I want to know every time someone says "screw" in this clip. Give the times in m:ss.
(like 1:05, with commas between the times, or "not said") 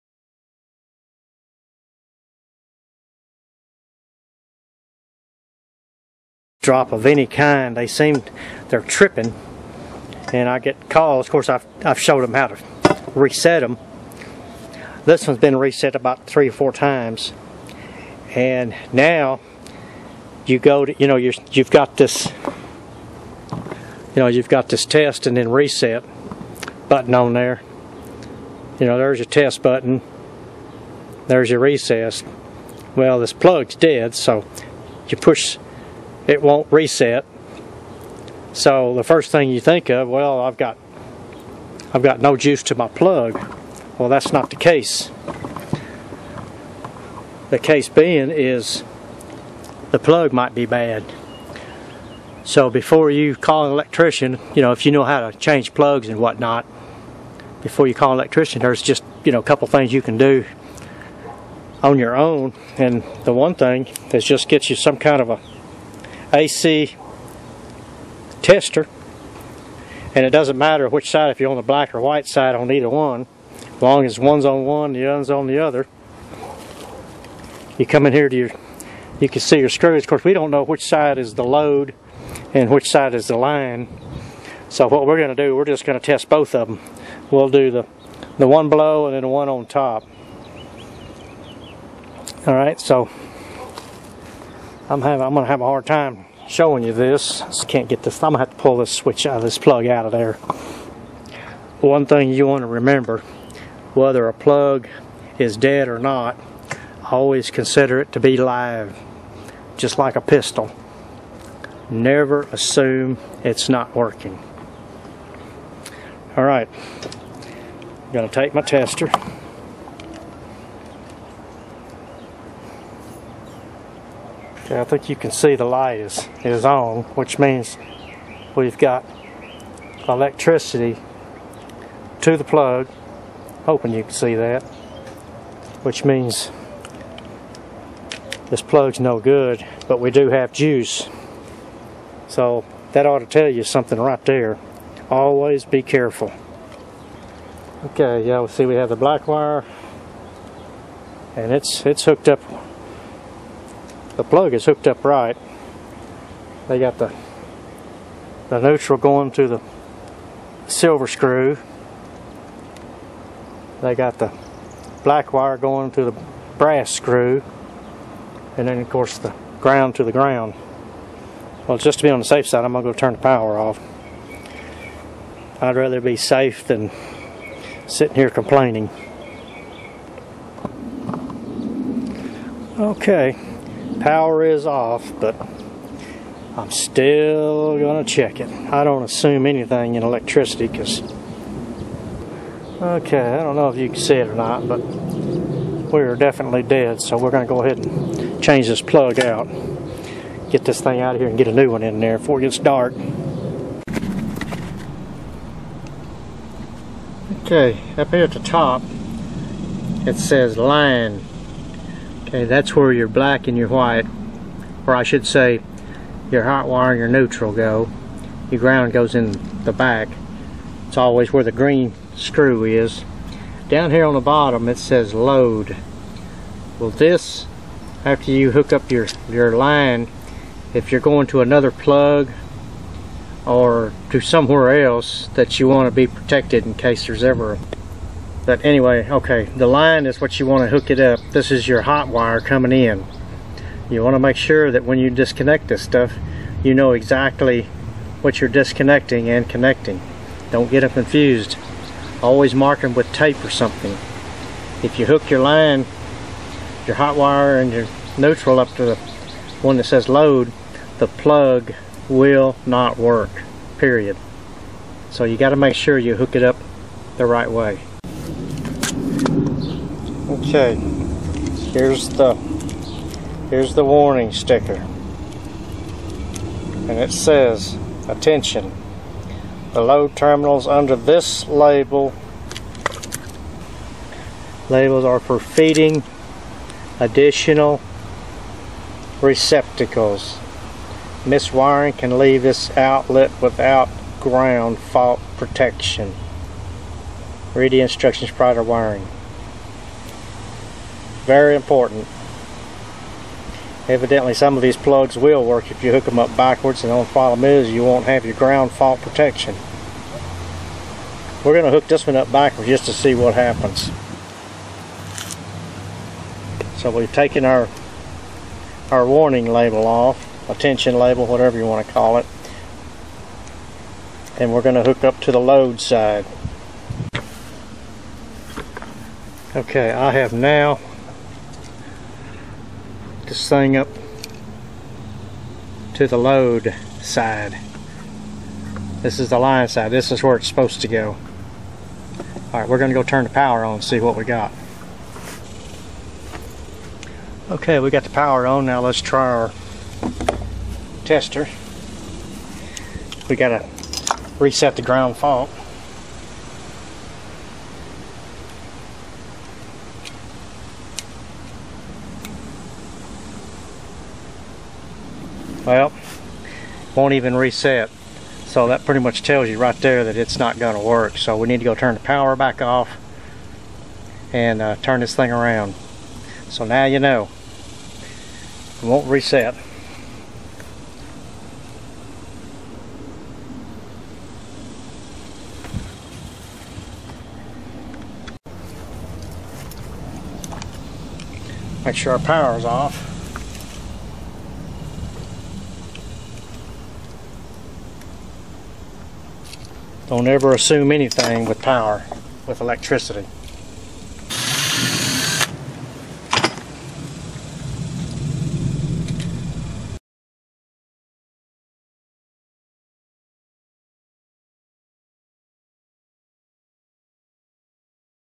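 1:19, 2:41, 2:46, 3:42.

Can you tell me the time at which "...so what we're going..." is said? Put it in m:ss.
1:24.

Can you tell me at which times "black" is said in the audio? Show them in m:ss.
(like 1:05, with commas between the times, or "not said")
1:11, 2:28, 2:45, 3:33.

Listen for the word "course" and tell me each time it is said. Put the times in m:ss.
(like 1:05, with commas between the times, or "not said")
0:11, 1:20, 2:48.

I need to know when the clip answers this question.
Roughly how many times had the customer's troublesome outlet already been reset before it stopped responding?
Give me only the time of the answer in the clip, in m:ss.
0:16.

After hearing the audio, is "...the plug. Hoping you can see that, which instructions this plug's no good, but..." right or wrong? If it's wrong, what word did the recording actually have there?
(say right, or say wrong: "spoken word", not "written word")
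wrong: "means", not "instructions".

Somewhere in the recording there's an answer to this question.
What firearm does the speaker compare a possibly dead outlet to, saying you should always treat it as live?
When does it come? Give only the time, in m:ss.
1:50.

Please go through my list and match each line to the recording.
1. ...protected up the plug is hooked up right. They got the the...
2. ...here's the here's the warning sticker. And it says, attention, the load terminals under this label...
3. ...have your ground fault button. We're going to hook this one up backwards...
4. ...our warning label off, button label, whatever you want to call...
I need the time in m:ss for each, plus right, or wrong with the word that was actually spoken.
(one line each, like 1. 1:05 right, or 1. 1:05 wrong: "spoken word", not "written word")
1. 2:32 wrong: "hooked", not "protected"
2. 4:31 right
3. 5:08 wrong: "protection", not "button"
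4. 5:18 wrong: "attention", not "button".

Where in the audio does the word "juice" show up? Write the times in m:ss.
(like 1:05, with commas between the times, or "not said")
0:42, 2:20.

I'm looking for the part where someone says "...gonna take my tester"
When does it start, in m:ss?
1:58.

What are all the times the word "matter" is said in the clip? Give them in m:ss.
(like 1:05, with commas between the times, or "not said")
1:10.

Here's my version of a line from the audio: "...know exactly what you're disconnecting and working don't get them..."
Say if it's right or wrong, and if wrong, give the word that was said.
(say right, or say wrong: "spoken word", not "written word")
wrong: "connecting", not "working".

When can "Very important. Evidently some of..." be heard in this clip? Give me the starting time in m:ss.
5:01.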